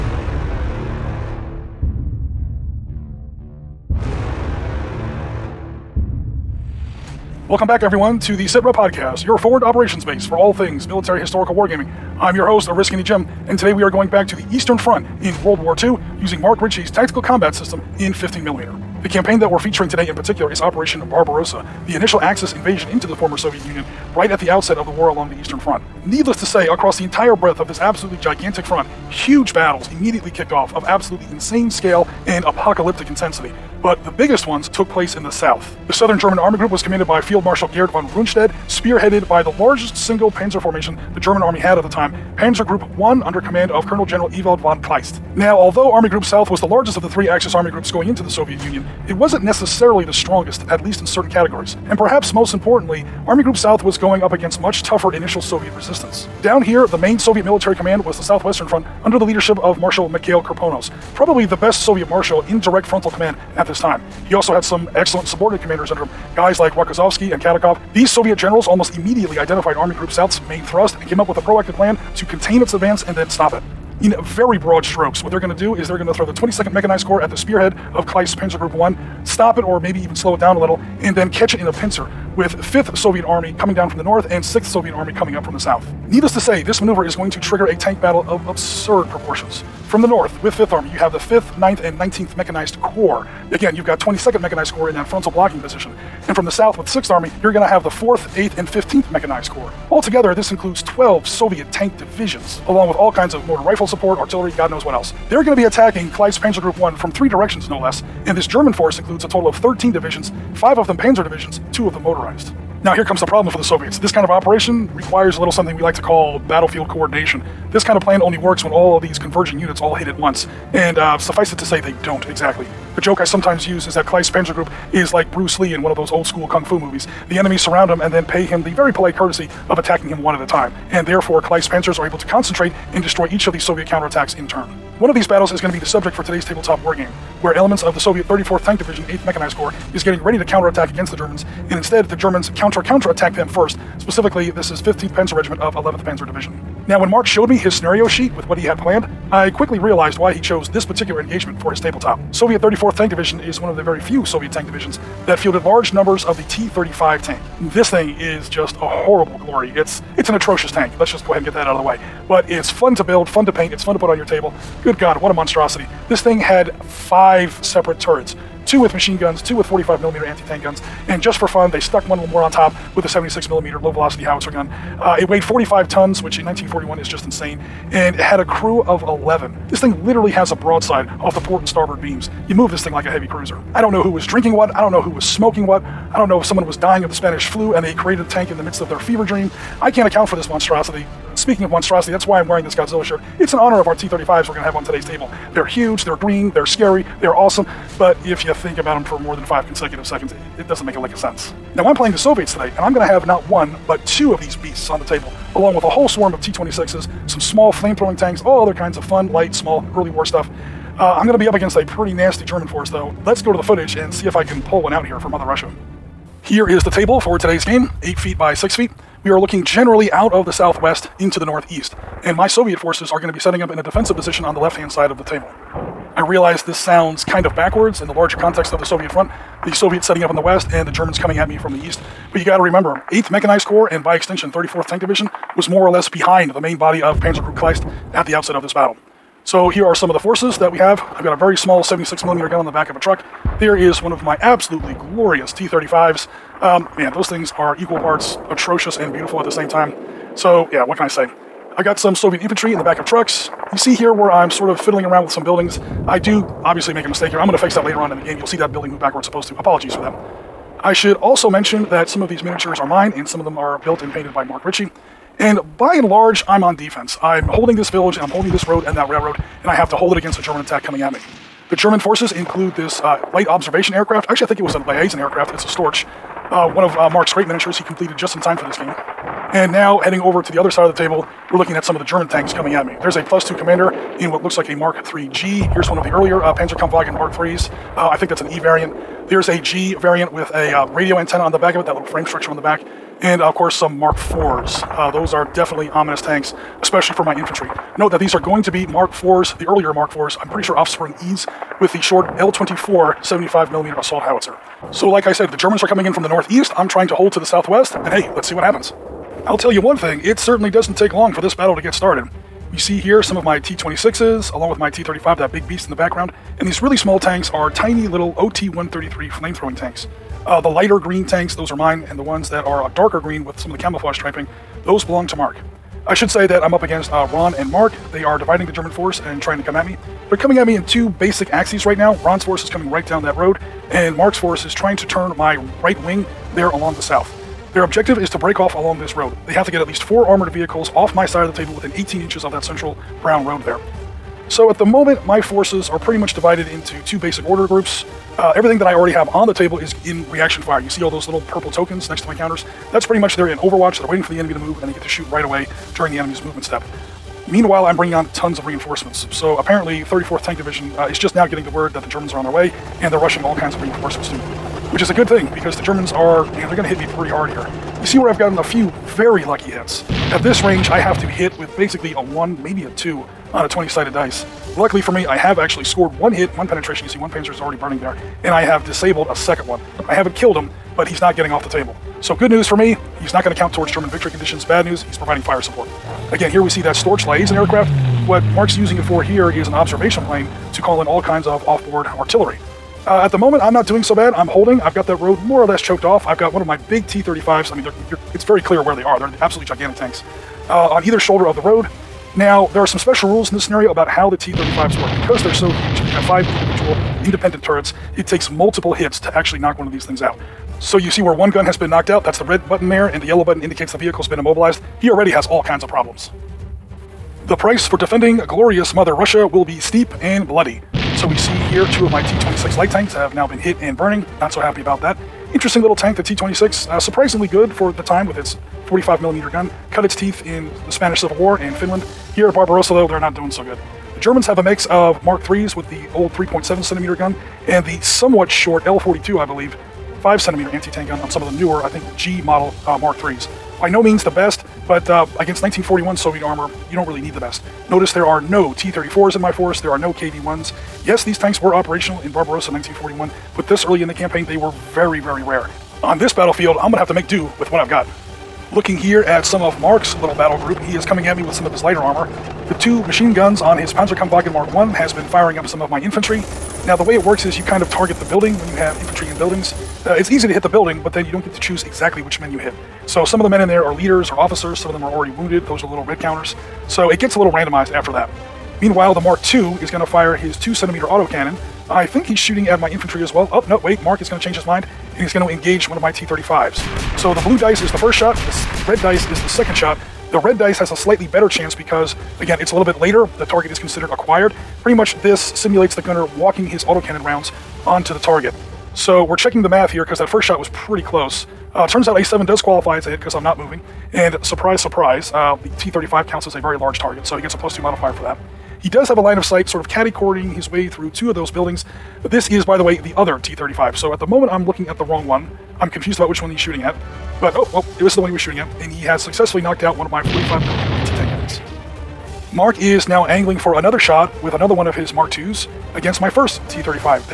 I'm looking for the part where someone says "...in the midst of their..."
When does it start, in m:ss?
3:08.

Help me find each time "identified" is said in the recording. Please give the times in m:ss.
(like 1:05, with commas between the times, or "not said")
1:09.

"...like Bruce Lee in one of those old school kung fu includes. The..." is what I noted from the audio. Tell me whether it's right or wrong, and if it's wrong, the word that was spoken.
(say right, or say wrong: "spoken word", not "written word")
wrong: "movies", not "includes".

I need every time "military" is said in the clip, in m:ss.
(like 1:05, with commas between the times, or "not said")
0:10, 0:57.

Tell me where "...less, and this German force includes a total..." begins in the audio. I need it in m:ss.
1:47.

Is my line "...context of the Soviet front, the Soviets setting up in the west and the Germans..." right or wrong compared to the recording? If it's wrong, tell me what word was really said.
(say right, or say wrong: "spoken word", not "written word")
right.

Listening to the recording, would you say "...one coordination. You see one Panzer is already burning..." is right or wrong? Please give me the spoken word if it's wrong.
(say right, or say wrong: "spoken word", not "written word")
wrong: "penetration", not "coordination".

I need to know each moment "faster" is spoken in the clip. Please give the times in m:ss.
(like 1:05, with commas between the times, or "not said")
not said.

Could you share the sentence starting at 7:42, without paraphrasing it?
The two machine guns on his Panzerkampfwagen Mark I has been firing up some of my infantry.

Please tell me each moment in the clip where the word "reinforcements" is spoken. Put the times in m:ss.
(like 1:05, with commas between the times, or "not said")
5:58, 6:03.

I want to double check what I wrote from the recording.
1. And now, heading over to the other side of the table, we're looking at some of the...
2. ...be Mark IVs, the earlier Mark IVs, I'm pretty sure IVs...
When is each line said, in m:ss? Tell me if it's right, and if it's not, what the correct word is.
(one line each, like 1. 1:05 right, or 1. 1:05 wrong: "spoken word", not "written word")
1. 4:39 right
2. 4:58 wrong: "Offspring", not "IVs".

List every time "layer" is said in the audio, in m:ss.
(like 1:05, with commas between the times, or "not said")
not said.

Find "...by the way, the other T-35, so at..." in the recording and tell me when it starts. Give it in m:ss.
8:32.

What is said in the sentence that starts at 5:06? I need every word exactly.
I'm trying to hold to the southwest, and hey, let's see what happens.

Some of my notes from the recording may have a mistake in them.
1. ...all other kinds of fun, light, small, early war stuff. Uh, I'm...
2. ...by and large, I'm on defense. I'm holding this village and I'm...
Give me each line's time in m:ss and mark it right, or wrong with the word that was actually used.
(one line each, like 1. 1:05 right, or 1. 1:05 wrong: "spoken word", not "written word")
1. 3:28 right
2. 4:25 right.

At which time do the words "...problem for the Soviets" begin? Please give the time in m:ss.
1:53.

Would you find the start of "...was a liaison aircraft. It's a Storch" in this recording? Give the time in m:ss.
4:34.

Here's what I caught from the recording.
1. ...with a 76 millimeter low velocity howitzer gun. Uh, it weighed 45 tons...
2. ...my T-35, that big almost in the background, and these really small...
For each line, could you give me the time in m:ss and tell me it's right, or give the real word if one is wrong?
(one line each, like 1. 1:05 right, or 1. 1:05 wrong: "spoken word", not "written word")
1. 2:52 right
2. 5:14 wrong: "beast", not "almost".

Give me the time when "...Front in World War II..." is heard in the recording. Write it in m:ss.
0:14.